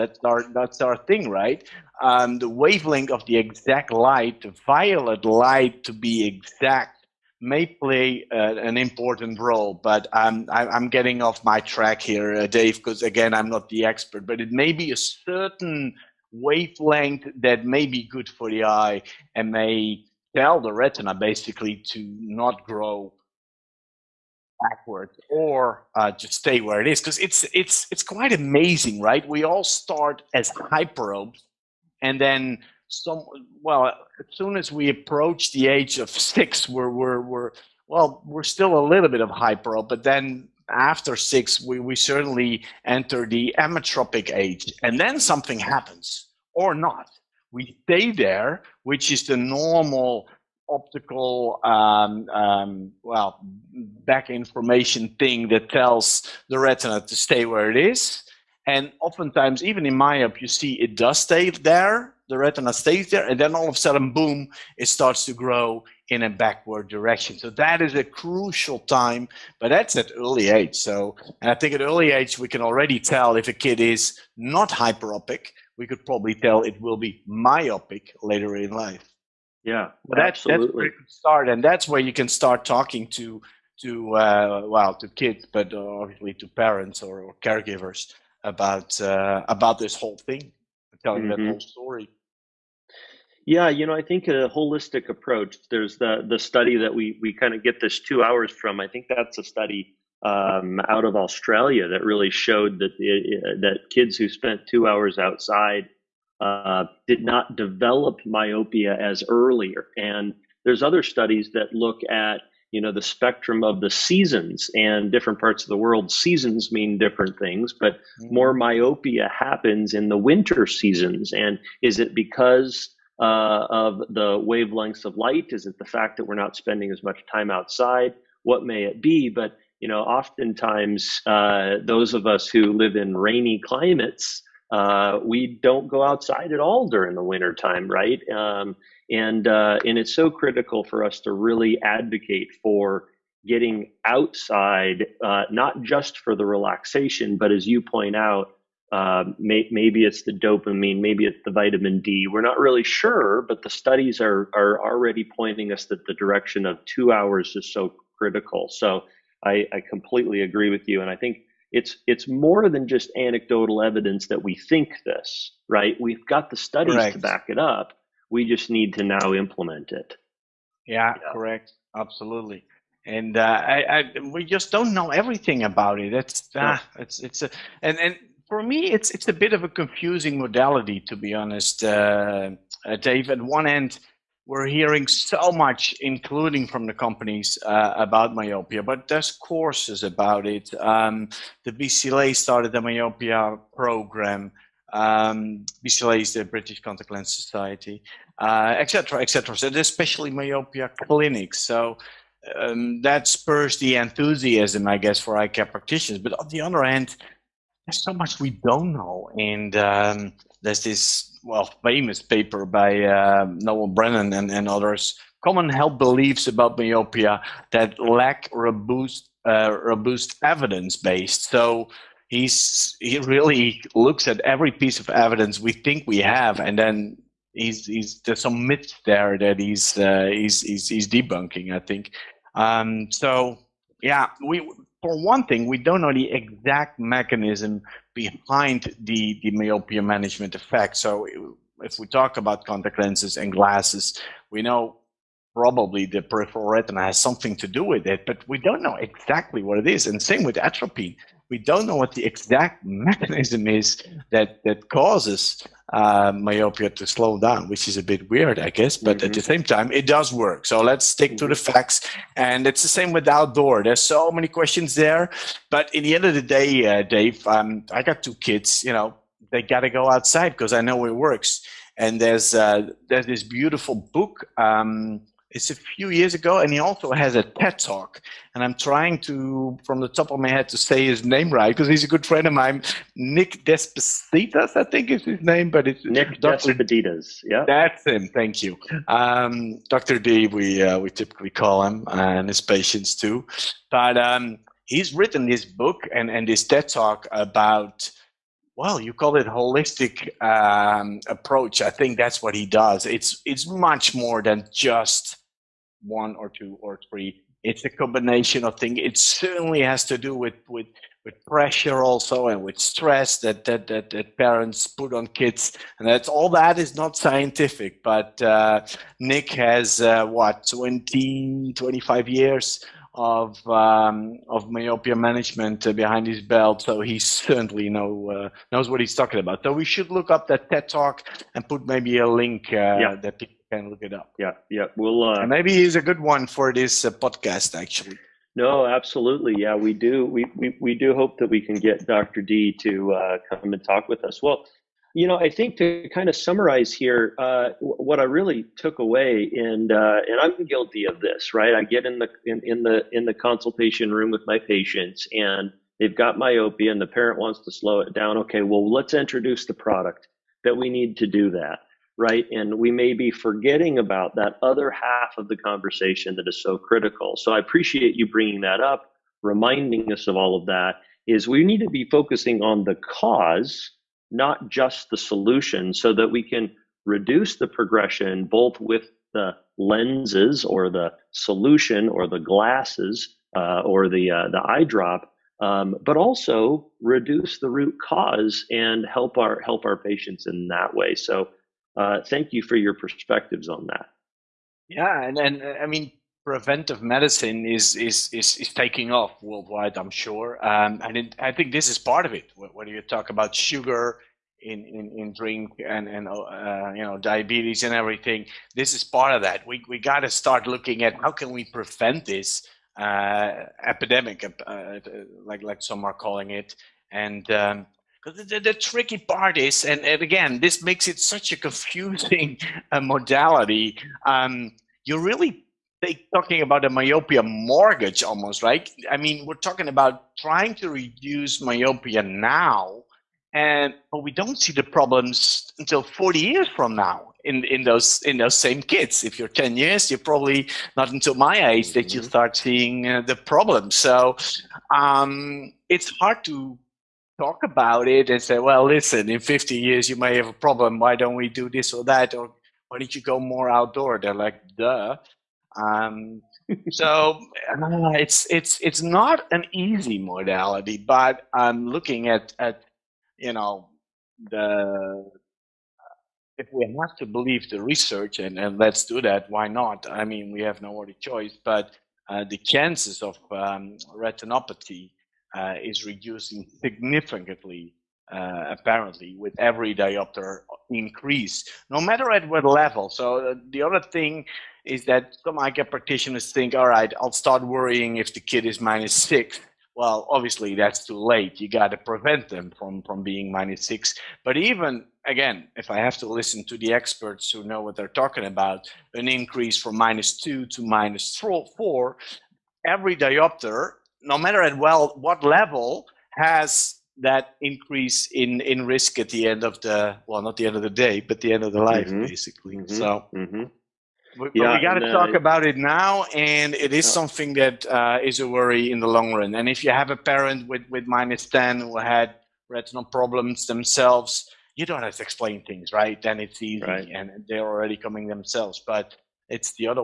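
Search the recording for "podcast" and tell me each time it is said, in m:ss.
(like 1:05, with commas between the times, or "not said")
5:37.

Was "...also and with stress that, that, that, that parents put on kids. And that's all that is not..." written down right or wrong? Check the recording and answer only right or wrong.
right.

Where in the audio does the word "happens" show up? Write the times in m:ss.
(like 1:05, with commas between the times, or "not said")
0:45, 1:59.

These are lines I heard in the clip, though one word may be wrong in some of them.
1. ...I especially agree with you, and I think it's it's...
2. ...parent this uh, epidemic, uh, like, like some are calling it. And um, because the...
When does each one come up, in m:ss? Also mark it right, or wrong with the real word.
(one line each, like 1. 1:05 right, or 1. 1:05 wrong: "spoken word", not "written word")
1. 2:39 wrong: "completely", not "especially"
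2. 6:51 wrong: "prevent", not "parent".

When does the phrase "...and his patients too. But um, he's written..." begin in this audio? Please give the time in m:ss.
4:52.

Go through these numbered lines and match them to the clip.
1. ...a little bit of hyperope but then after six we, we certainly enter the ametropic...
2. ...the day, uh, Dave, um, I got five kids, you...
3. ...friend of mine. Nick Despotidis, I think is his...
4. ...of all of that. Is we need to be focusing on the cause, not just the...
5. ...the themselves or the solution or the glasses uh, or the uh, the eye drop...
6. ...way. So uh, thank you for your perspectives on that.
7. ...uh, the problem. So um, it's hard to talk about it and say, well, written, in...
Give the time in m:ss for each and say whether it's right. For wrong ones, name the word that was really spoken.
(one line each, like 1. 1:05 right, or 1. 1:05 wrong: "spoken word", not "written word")
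1. 0:38 right
2. 4:26 wrong: "two", not "five"
3. 4:42 right
4. 6:10 right
5. 6:19 wrong: "lenses", not "themselves"
6. 6:30 right
7. 7:23 wrong: "listen", not "written".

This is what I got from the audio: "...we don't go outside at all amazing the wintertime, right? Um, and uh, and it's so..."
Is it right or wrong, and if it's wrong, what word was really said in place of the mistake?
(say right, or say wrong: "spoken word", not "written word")
wrong: "during", not "amazing".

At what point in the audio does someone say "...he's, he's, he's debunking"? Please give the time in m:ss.
3:50.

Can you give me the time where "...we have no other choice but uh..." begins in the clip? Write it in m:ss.
7:50.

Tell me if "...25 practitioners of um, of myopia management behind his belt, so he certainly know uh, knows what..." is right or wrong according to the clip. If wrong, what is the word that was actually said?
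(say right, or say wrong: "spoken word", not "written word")
wrong: "years", not "practitioners".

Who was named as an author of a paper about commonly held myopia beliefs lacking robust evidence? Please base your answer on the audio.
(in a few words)
Noel Brennan.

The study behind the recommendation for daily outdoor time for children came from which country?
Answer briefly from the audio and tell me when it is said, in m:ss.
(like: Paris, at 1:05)
Australia, at 1:41.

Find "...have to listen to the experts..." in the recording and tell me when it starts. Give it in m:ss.
8:15.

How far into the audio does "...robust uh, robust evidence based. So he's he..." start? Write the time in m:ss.
3:38.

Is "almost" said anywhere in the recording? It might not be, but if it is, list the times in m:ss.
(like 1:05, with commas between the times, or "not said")
7:08.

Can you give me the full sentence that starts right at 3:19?
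Et so there's especially myopia clinics.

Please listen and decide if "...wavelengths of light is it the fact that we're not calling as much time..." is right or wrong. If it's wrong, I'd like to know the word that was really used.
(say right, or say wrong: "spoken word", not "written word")
wrong: "spending", not "calling".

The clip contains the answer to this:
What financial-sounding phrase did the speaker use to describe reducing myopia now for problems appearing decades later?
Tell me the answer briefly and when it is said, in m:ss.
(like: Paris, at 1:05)
Myopia mortgage, at 7:06.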